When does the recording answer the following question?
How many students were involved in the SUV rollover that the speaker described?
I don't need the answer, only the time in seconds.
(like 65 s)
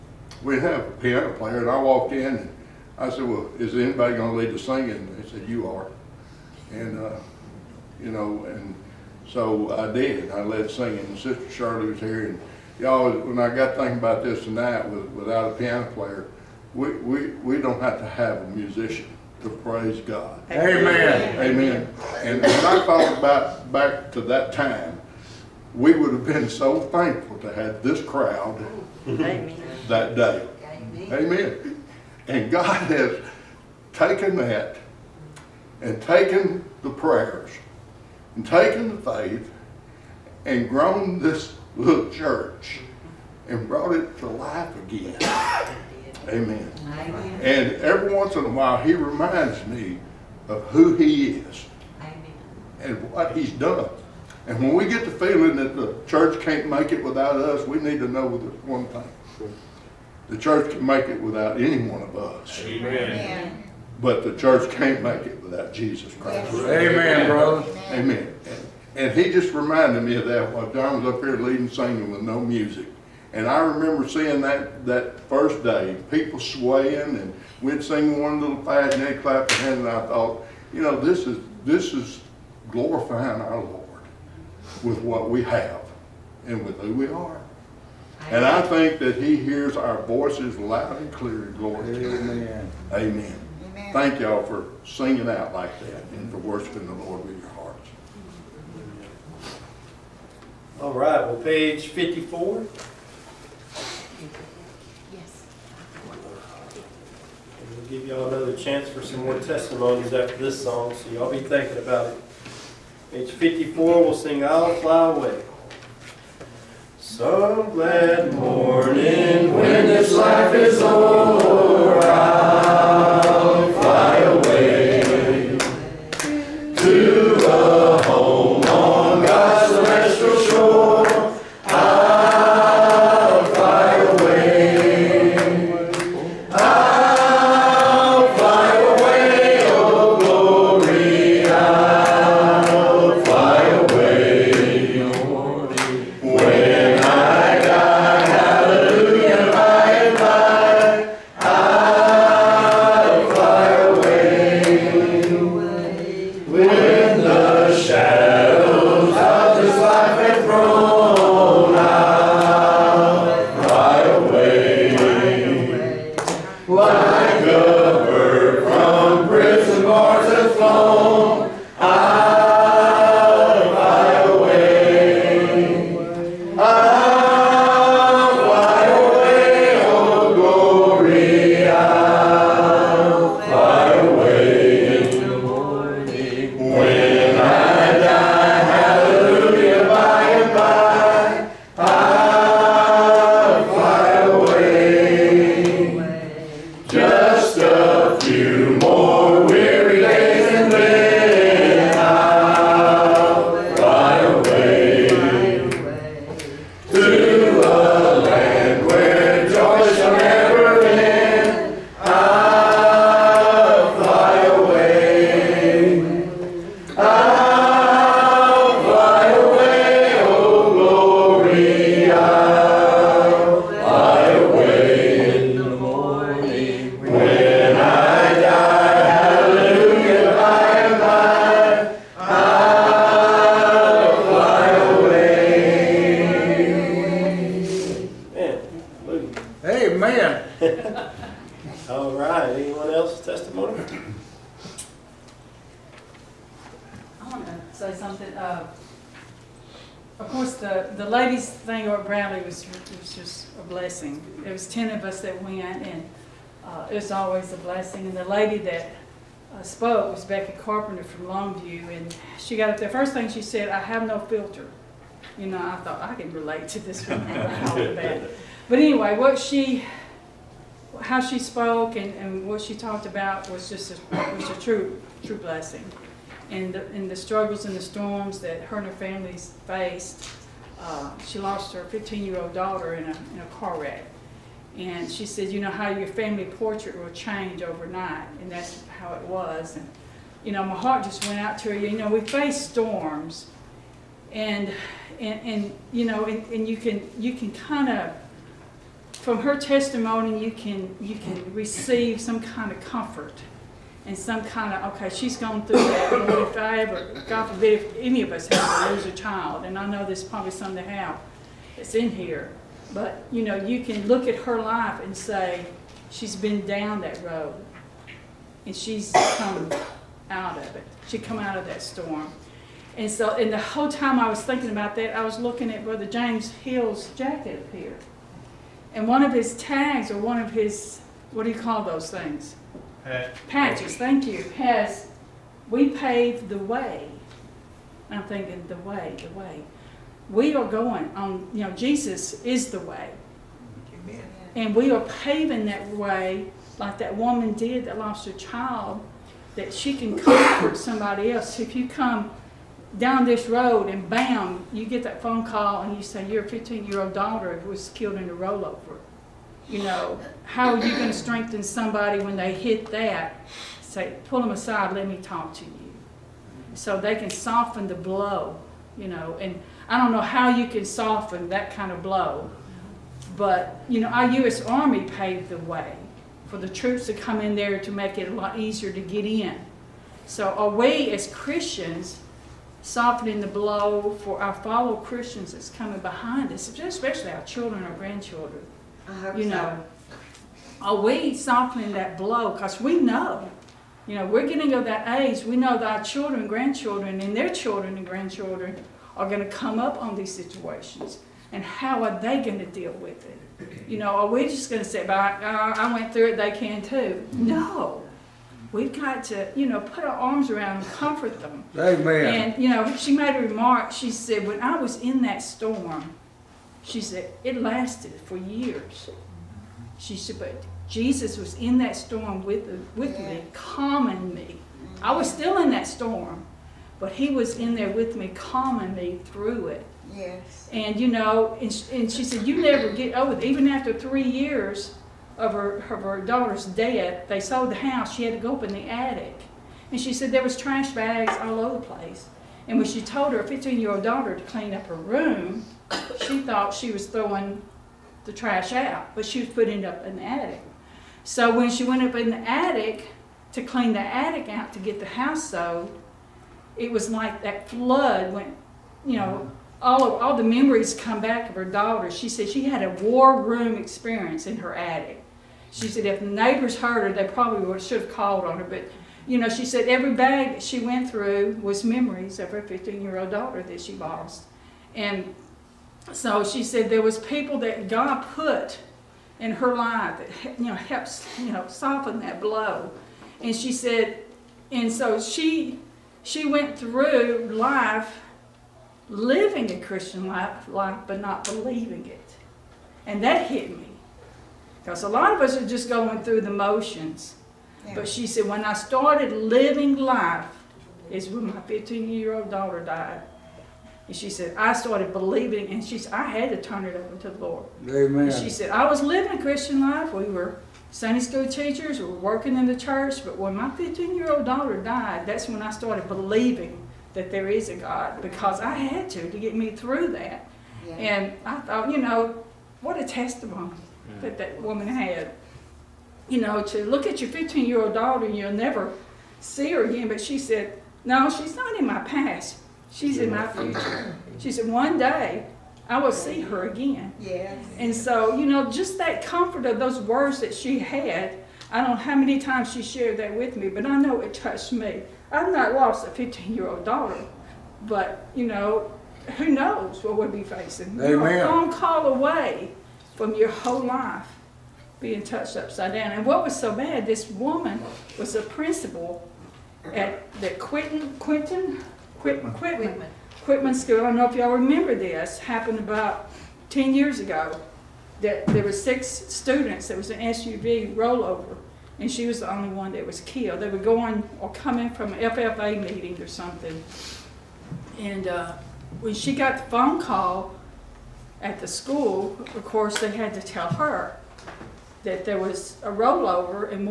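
568 s.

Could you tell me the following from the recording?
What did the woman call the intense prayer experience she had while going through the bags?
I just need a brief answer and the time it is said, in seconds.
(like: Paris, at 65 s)
War room experience, at 463 s.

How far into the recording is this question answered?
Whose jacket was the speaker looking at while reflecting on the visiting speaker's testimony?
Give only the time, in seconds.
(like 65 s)
325 s.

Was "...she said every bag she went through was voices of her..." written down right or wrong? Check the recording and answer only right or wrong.
wrong.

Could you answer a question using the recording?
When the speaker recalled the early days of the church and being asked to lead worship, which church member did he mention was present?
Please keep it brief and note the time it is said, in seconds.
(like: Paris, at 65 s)
Sister Shirley, at 11 s.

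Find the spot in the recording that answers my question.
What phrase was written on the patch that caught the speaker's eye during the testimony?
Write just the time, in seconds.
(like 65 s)
335 s.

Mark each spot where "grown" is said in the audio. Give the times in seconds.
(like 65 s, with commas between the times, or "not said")
40 s.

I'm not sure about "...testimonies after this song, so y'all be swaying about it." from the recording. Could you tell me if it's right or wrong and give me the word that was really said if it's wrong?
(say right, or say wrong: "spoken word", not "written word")
wrong: "thinking", not "swaying".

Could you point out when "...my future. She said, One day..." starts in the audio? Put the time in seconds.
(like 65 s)
533 s.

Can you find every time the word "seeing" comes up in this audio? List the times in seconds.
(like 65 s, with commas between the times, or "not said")
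74 s.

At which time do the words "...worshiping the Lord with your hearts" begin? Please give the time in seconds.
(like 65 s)
96 s.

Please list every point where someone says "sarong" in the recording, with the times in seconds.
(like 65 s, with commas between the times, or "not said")
not said.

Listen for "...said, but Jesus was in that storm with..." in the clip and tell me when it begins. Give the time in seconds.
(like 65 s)
420 s.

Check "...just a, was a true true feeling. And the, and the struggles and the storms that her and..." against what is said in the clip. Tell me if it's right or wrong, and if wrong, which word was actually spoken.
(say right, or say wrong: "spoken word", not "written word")
wrong: "blessing", not "feeling".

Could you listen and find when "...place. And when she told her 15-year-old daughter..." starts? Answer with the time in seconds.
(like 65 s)
441 s.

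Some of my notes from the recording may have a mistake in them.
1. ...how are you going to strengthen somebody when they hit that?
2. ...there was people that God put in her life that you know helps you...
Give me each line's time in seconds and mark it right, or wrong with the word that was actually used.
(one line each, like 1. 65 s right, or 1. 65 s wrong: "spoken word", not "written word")
1. 360 s right
2. 476 s right.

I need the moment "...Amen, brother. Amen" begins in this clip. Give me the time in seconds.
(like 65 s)
66 s.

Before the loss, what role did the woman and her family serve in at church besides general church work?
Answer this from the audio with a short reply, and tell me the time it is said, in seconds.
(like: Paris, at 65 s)
Sunday school teachers, at 510 s.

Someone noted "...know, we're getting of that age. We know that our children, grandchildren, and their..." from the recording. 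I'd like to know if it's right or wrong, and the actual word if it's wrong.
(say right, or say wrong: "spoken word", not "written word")
right.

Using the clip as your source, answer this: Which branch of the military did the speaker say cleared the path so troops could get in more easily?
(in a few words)
U.S. Army.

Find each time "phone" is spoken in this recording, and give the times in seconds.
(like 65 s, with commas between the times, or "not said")
355 s, 579 s.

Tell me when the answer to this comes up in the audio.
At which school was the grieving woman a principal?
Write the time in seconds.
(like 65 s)
563 s.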